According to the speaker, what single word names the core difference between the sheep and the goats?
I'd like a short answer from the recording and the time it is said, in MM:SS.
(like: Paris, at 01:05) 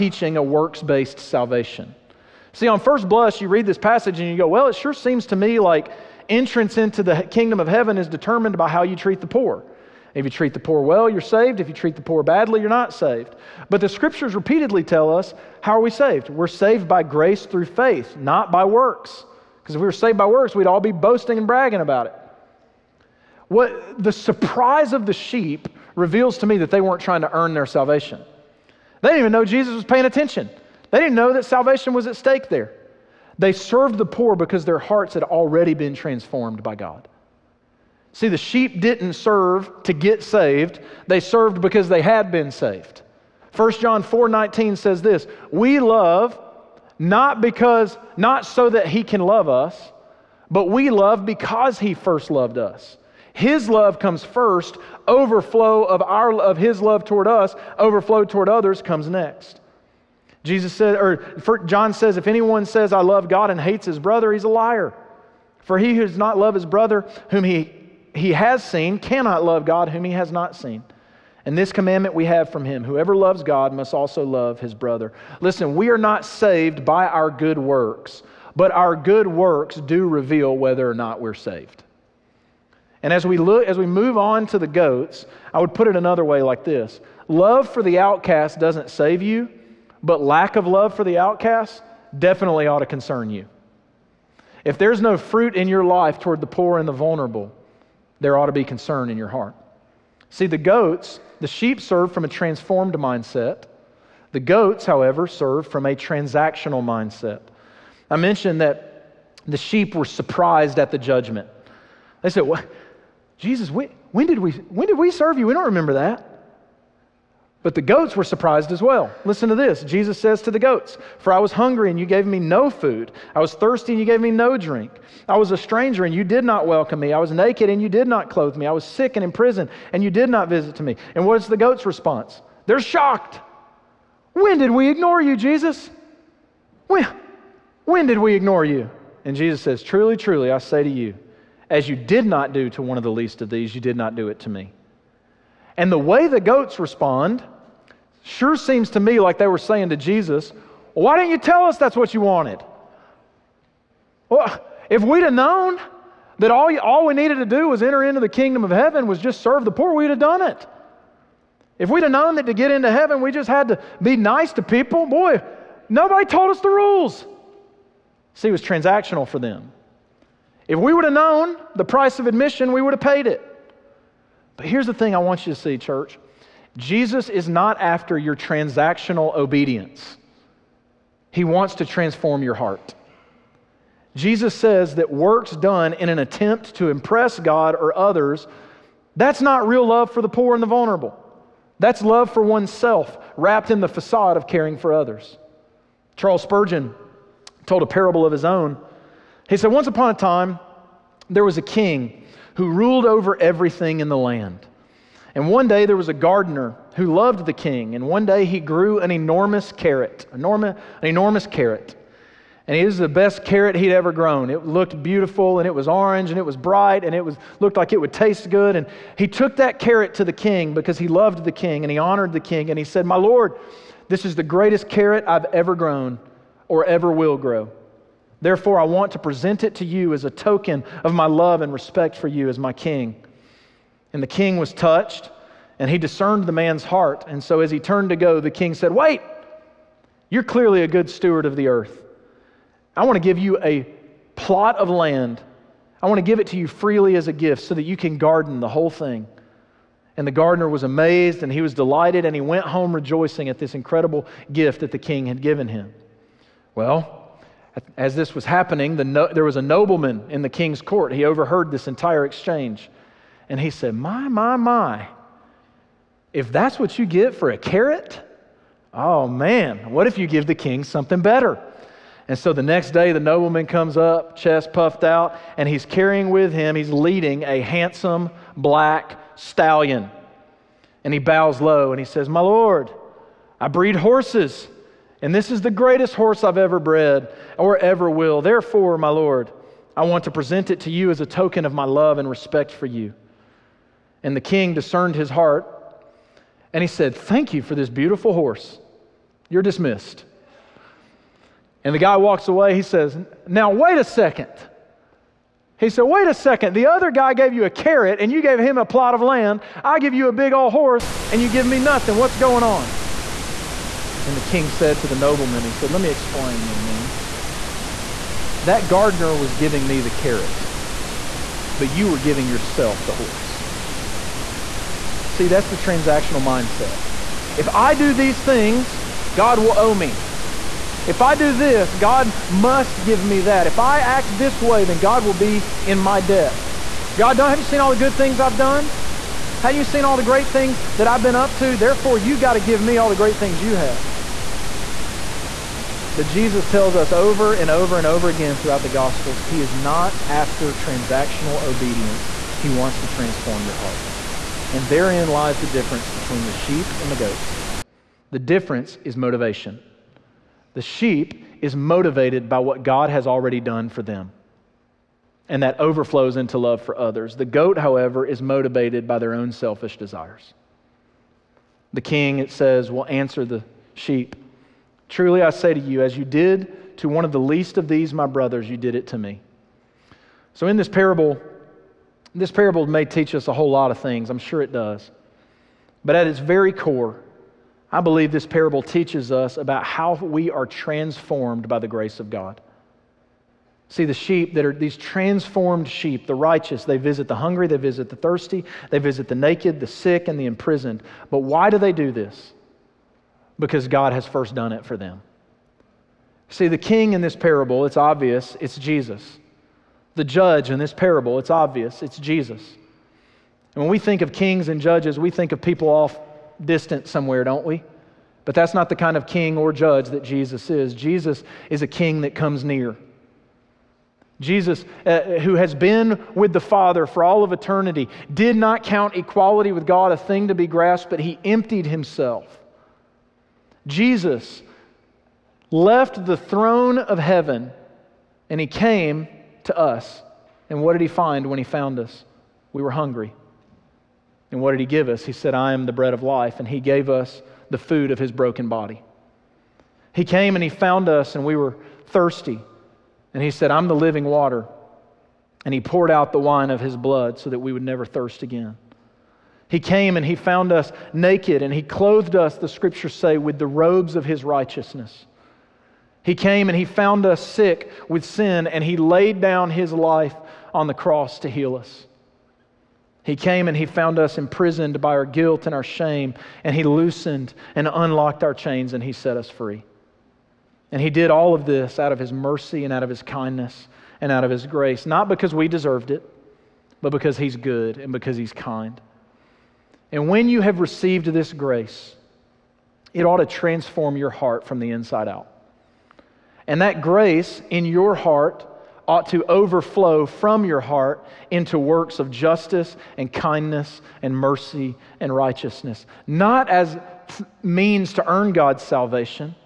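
motivation, at 05:59.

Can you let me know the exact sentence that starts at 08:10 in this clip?
And when you have received this grace, it ought to transform your heart from the inside out.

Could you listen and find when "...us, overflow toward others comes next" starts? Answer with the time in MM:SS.
00:57.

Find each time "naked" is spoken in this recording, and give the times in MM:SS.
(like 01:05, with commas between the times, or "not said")
02:07, 06:39, 07:41.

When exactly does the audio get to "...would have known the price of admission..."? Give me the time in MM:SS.
02:50.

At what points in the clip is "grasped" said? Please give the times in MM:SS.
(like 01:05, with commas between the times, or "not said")
07:10.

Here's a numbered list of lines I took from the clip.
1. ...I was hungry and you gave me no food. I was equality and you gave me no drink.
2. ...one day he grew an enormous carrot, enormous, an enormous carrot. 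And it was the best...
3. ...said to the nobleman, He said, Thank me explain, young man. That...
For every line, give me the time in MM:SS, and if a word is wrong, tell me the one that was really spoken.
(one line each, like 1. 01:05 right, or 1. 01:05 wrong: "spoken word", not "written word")
1. 02:01 wrong: "thirsty", not "equality"
2. 03:28 right
3. 05:14 wrong: "Let", not "Thank".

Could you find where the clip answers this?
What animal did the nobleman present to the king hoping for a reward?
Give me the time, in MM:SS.
04:38.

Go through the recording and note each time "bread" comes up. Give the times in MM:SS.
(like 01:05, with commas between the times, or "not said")
07:25.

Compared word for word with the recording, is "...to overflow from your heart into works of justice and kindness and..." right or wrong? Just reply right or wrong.
right.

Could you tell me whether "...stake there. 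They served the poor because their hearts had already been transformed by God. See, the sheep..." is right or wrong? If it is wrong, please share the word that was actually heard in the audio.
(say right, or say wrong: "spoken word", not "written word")
right.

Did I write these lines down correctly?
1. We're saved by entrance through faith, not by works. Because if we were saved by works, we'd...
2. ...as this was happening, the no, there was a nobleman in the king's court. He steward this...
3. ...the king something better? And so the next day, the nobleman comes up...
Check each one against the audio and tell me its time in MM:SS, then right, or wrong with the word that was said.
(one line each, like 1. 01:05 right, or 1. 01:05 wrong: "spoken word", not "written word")
1. 00:16 wrong: "grace", not "entrance"
2. 04:17 wrong: "overheard", not "steward"
3. 04:30 right.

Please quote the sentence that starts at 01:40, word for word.
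See, the goats, the sheep serve from a transformed mindset.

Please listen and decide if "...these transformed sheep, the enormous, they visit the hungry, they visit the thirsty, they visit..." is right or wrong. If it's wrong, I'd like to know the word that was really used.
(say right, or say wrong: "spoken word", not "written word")
wrong: "righteous", not "enormous".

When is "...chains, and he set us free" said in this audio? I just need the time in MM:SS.
07:58.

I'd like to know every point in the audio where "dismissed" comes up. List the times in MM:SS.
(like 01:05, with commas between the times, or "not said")
04:59.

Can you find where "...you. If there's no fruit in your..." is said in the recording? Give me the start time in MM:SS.
01:33.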